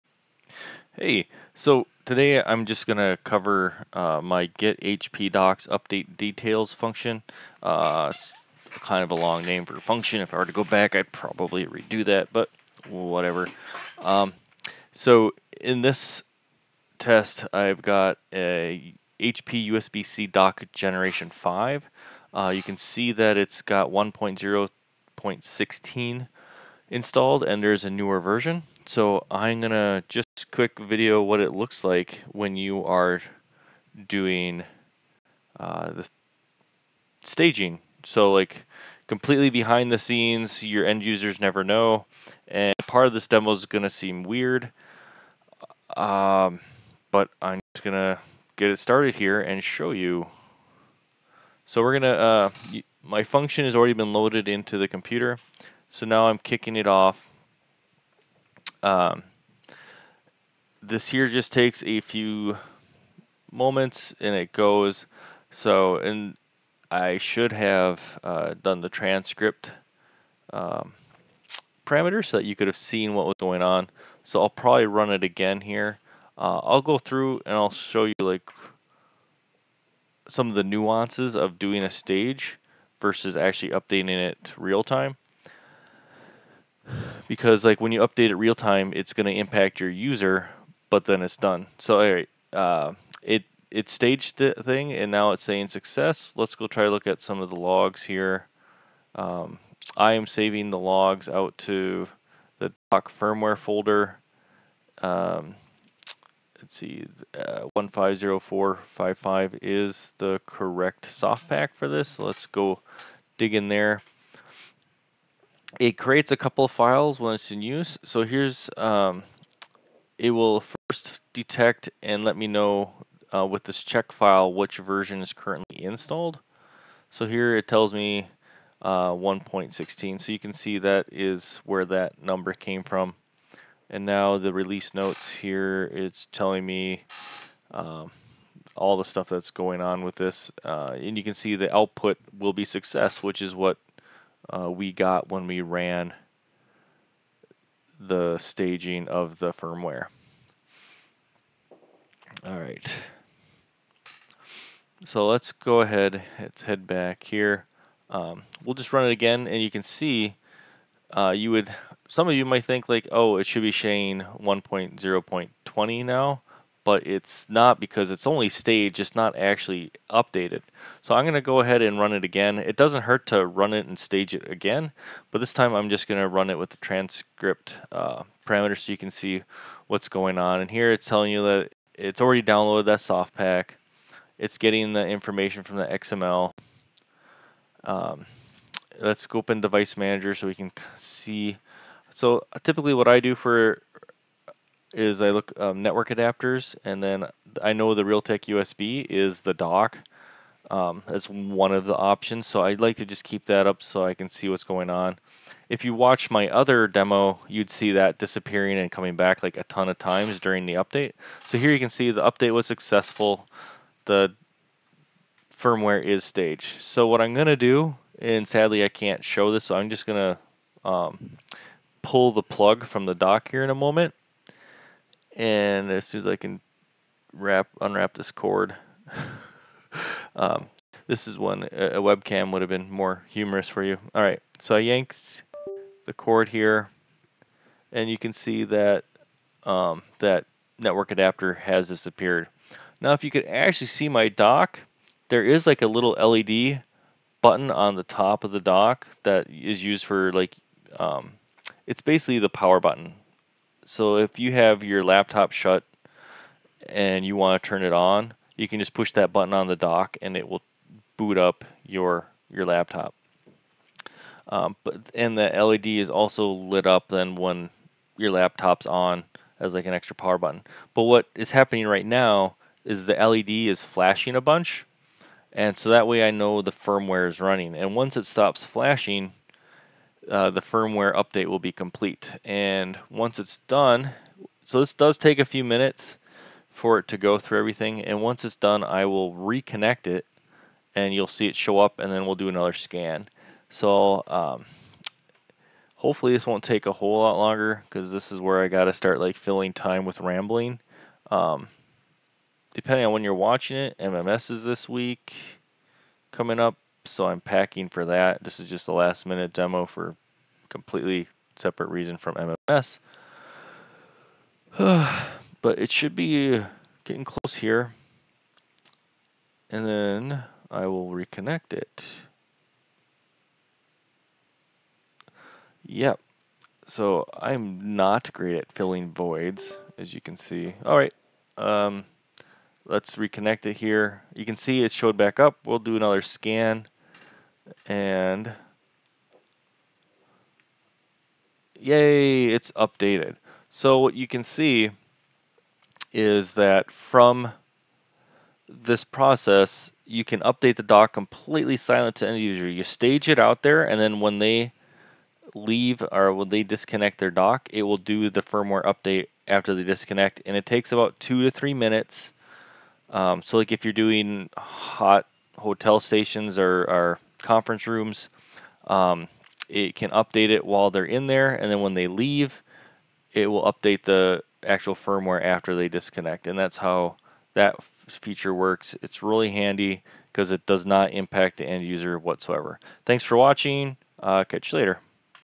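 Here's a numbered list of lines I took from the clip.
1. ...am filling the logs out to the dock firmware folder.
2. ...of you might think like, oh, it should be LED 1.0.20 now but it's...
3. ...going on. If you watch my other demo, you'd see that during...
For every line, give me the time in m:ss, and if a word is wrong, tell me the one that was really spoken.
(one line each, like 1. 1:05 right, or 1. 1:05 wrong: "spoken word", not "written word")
1. 1:40 wrong: "saving", not "filling"
2. 2:42 wrong: "Shane", not "LED"
3. 3:24 wrong: "disappearing", not "during".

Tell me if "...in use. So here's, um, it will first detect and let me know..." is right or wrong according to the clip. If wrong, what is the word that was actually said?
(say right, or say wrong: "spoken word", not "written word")
right.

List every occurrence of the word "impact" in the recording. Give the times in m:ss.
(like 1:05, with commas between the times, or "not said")
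1:29, 6:21.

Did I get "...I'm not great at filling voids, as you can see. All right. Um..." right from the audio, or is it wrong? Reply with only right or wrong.
right.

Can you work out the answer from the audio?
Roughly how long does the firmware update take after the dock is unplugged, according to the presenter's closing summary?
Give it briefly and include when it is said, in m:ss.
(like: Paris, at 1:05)
2 to 3 minutes, at 6:01.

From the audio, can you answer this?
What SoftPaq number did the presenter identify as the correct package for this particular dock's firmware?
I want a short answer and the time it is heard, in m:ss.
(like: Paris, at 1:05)
150455, at 1:47.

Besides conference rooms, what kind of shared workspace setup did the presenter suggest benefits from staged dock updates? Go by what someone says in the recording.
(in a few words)
hotel stations.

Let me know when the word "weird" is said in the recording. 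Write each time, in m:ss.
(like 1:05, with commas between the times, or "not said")
0:44.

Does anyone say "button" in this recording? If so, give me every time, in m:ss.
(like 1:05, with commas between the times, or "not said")
4:07, 4:12, 4:19, 4:30.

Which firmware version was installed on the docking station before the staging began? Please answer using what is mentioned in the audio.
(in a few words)
1.0.16.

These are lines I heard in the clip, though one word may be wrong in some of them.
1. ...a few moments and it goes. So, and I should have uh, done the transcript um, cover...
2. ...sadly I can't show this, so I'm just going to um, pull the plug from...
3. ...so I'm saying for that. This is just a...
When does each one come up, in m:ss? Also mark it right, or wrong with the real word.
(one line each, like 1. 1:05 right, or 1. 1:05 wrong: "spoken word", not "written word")
1. 1:01 wrong: "parameter", not "cover"
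2. 3:38 right
3. 5:07 wrong: "packing", not "saying".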